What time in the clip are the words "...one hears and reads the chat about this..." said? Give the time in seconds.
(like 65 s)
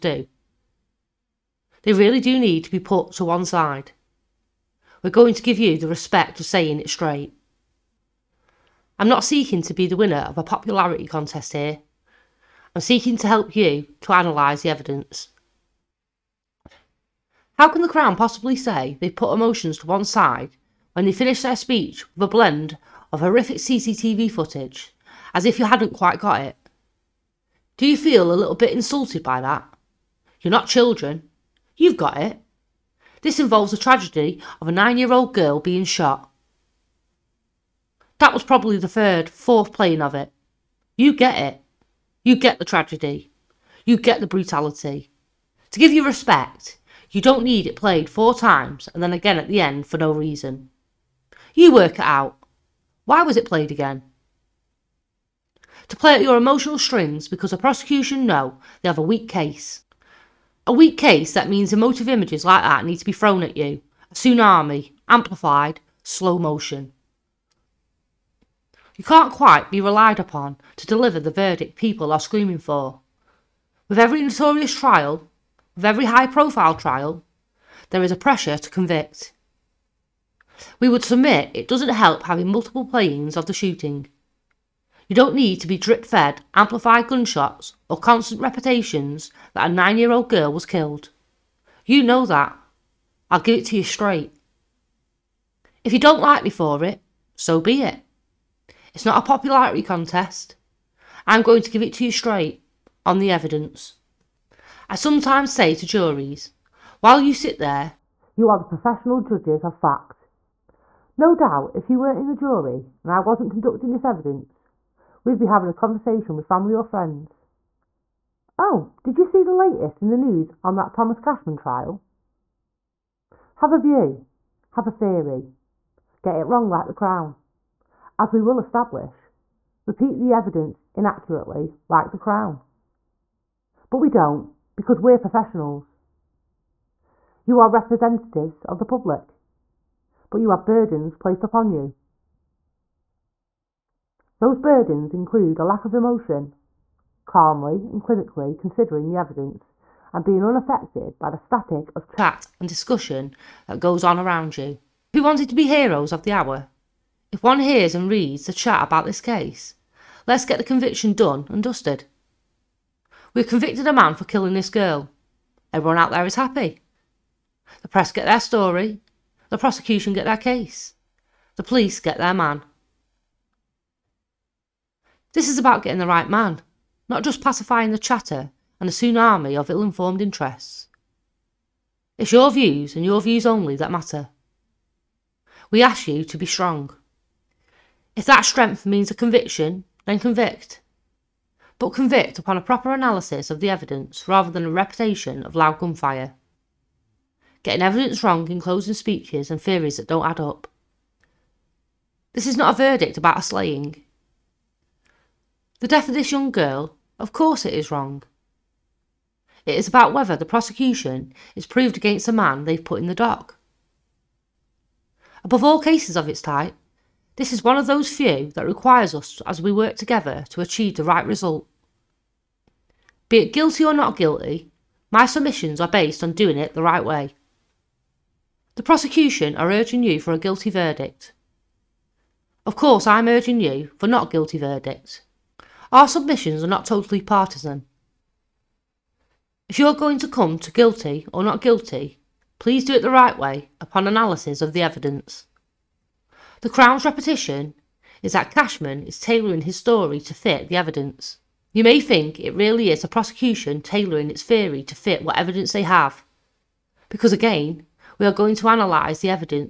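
157 s.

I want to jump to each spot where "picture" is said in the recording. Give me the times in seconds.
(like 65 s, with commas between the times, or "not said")
not said.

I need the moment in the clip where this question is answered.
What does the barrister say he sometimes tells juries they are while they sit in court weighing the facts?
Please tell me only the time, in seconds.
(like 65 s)
108 s.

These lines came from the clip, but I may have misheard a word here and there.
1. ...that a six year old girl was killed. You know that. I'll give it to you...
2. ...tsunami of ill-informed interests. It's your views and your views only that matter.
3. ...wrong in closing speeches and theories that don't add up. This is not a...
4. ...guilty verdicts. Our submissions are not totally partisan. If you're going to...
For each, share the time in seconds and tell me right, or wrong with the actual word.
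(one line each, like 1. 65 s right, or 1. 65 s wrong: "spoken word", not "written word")
1. 89 s wrong: "nine", not "six"
2. 178 s right
3. 198 s right
4. 234 s right.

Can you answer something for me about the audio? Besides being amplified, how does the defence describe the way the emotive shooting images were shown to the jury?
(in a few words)
slow motion.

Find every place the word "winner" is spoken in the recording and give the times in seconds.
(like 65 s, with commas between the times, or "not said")
9 s.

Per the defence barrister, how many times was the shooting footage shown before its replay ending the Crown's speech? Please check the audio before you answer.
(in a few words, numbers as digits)
4.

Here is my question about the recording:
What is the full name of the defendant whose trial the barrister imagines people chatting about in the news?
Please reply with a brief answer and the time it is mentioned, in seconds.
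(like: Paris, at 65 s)
Thomas Cashman, at 120 s.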